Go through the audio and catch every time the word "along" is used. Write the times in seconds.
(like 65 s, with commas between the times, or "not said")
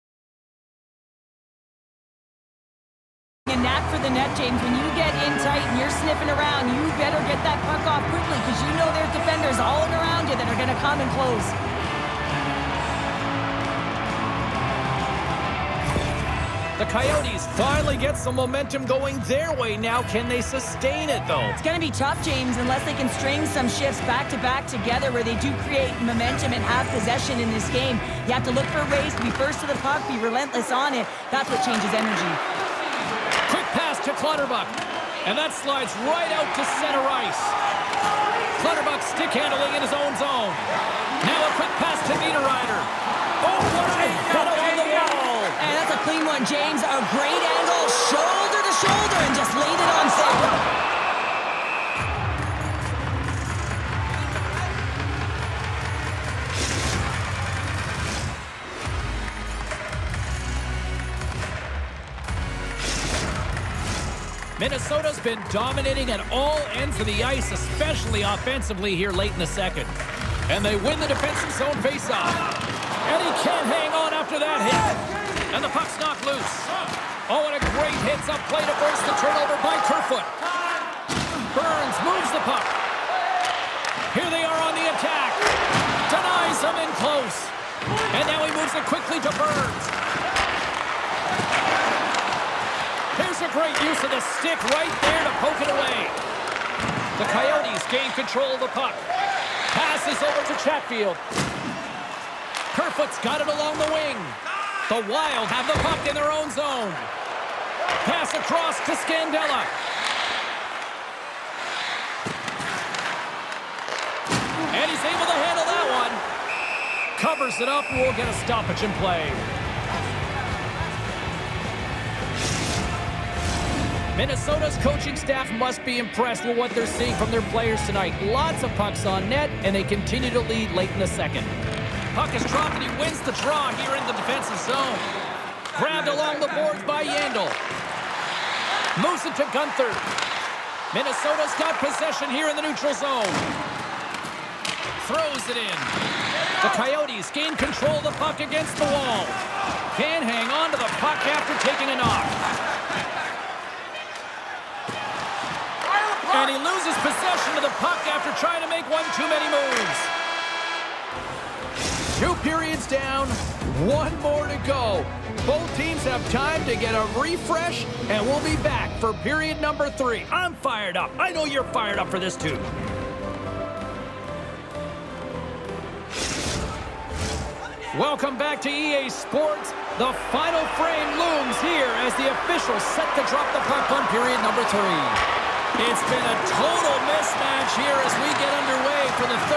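103 s, 136 s.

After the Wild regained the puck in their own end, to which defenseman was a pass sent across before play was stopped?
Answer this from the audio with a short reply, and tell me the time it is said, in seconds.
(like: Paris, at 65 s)
Scandella, at 109 s.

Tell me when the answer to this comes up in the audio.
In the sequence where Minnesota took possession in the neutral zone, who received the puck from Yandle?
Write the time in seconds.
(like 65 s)
139 s.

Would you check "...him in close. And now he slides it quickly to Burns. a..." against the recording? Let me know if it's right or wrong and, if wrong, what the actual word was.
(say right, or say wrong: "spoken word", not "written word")
wrong: "moves", not "slides".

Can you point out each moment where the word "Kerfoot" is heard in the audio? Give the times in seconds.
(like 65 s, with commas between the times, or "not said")
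79 s, 102 s.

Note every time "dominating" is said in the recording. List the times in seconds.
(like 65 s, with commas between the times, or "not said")
65 s.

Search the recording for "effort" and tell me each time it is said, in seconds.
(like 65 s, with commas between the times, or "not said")
not said.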